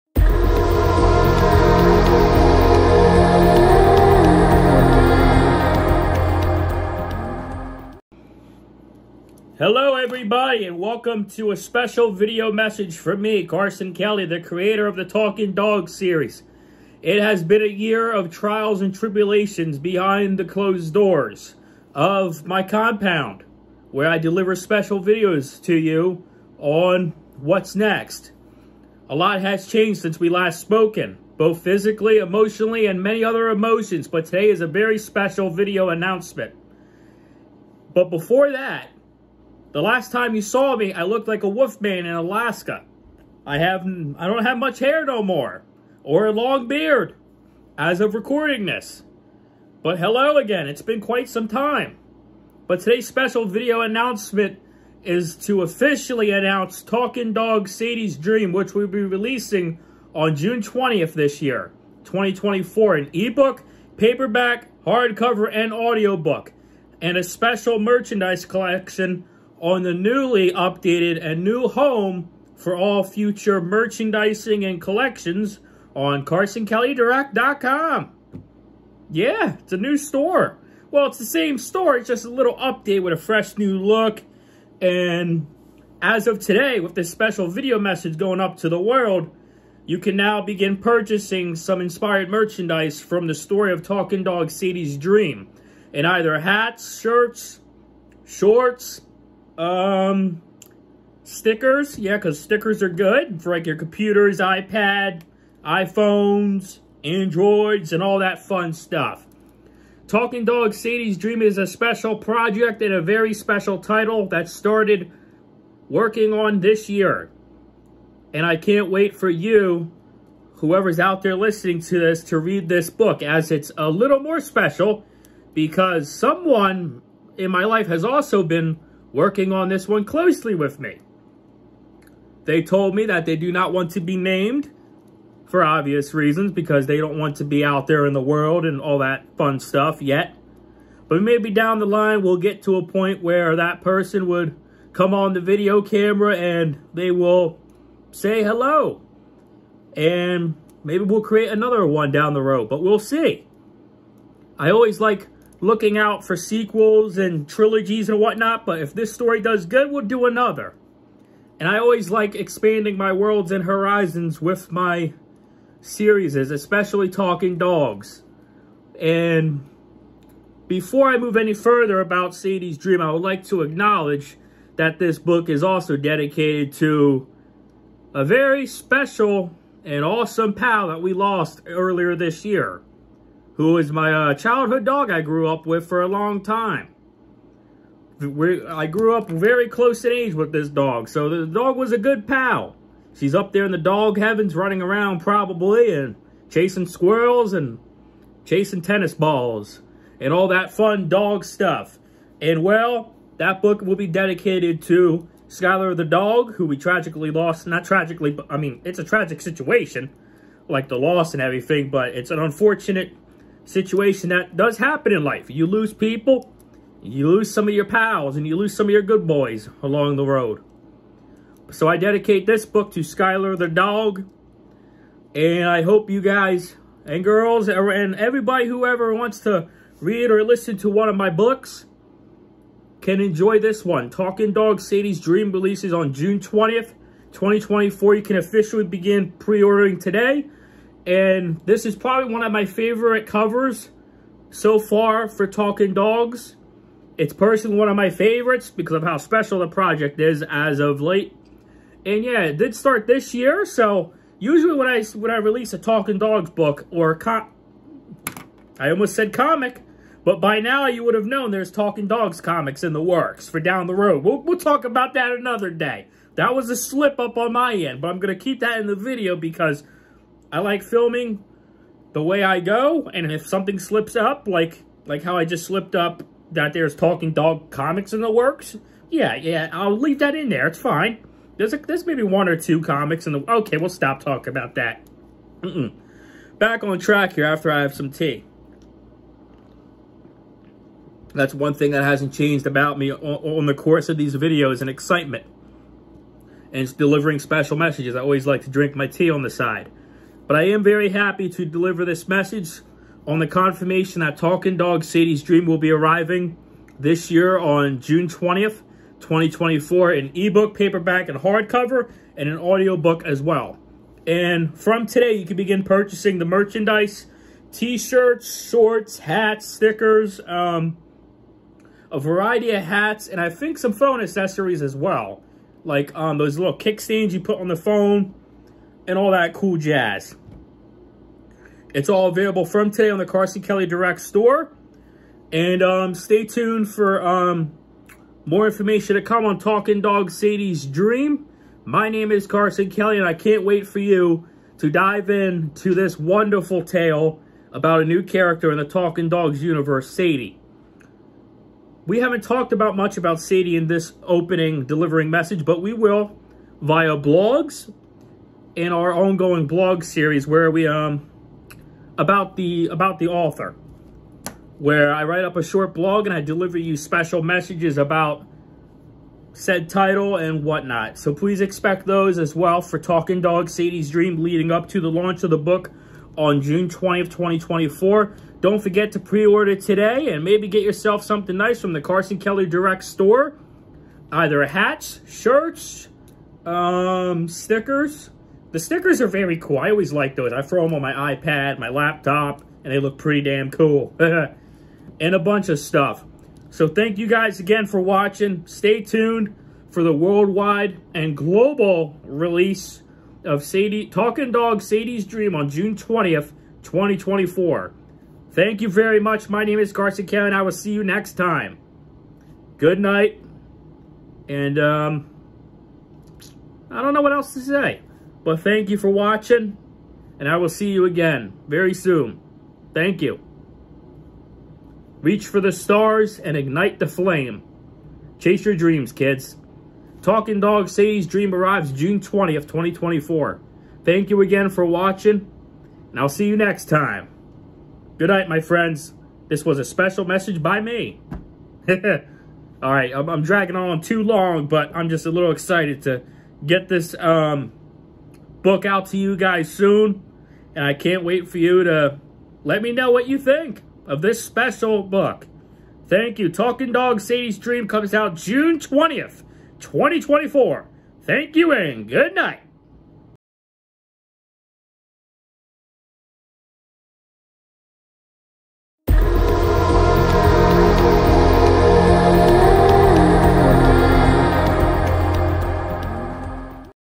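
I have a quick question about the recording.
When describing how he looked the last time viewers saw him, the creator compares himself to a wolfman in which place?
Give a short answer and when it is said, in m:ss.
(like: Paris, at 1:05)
Alaska, at 0:42.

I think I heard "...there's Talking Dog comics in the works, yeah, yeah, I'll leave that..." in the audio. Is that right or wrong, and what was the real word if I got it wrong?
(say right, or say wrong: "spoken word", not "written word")
right.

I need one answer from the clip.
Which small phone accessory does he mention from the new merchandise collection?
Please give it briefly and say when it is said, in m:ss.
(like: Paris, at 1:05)
kickstands, at 5:26.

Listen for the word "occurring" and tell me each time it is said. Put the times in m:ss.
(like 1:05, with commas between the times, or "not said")
not said.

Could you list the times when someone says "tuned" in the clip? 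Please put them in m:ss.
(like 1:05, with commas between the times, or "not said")
5:36, 6:39.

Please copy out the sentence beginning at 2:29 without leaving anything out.
And maybe we'll create another one down the road, but we'll see.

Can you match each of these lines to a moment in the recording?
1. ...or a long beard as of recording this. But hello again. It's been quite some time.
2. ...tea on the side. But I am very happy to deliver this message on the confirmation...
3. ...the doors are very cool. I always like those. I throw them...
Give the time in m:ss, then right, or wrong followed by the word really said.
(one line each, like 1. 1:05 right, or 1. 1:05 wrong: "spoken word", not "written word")
1. 0:46 right
2. 4:59 right
3. 6:28 wrong: "stickers", not "doors".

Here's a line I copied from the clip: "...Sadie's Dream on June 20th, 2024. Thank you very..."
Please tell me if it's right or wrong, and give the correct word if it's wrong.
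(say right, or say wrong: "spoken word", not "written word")
right.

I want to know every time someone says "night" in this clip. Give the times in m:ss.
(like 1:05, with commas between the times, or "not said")
6:53, 7:18, 7:42.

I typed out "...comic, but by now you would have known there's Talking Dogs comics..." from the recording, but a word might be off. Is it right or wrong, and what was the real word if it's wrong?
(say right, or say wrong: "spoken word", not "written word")
right.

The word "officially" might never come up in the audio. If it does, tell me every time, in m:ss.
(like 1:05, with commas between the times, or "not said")
0:55, 3:58.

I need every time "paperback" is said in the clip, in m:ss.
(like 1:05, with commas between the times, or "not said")
1:03, 5:10.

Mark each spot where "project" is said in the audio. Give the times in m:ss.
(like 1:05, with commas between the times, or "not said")
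1:52, 4:09.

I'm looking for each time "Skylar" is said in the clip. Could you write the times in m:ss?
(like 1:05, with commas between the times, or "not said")
3:25, 3:43.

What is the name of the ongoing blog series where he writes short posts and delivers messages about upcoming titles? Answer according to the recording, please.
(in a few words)
About the author.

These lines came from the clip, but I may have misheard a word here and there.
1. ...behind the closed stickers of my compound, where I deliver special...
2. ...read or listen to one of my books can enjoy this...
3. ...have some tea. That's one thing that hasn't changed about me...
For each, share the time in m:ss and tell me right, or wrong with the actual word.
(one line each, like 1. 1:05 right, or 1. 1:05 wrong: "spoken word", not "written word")
1. 0:19 wrong: "doors", not "stickers"
2. 3:50 right
3. 4:47 right.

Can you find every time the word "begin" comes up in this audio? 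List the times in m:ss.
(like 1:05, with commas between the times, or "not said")
1:30, 3:58, 5:15.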